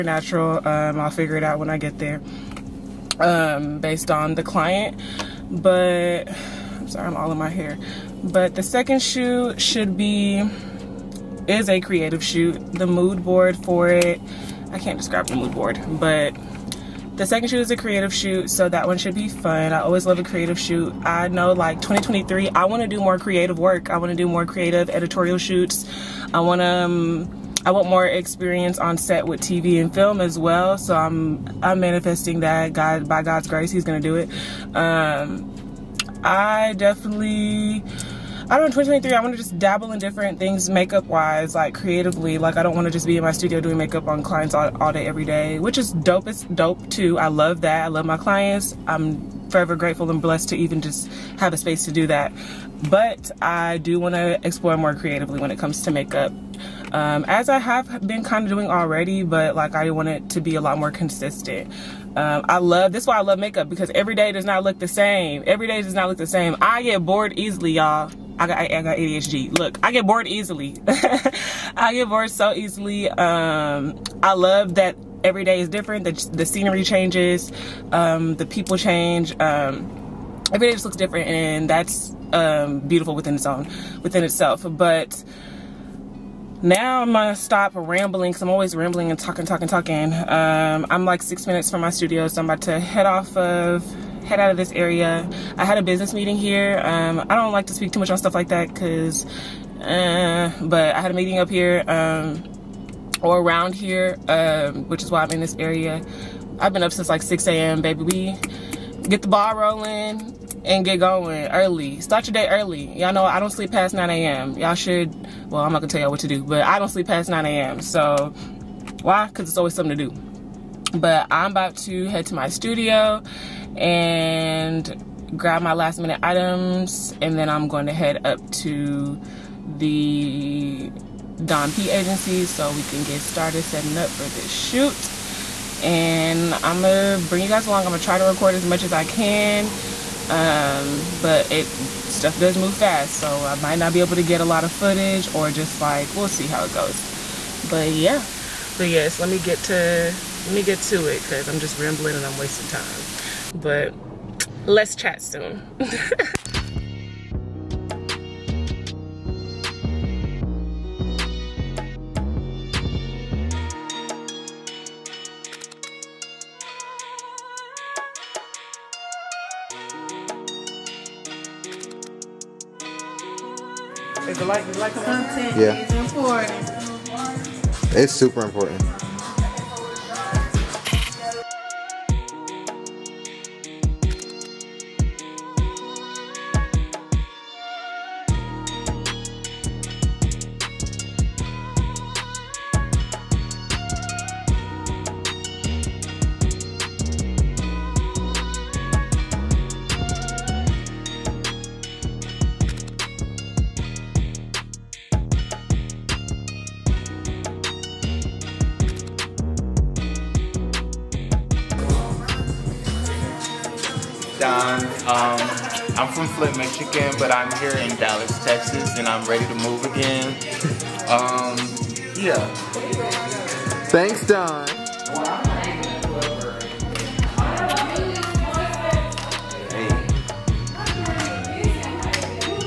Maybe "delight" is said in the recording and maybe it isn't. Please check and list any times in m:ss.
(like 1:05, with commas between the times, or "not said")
not said.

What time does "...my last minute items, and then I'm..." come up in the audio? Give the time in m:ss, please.
2:05.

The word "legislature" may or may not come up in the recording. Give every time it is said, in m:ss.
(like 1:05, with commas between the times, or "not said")
not said.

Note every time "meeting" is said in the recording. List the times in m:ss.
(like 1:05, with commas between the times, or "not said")
1:36, 1:41.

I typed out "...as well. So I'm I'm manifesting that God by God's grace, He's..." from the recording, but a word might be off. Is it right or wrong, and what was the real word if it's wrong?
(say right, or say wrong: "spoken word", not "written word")
right.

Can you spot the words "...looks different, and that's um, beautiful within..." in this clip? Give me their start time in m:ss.
1:20.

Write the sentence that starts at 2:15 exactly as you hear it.
And I'm gonna bring you guys along.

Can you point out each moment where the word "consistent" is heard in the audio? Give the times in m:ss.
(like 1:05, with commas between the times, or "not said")
1:00.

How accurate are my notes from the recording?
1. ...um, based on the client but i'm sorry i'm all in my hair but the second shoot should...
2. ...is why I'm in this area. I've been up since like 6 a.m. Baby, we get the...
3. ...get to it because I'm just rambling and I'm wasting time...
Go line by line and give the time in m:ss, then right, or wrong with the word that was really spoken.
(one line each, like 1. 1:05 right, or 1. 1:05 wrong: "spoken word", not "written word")
1. 0:03 right
2. 1:45 right
3. 2:30 right.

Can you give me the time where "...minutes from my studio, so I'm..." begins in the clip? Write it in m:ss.
1:31.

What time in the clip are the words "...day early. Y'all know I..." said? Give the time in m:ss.
1:52.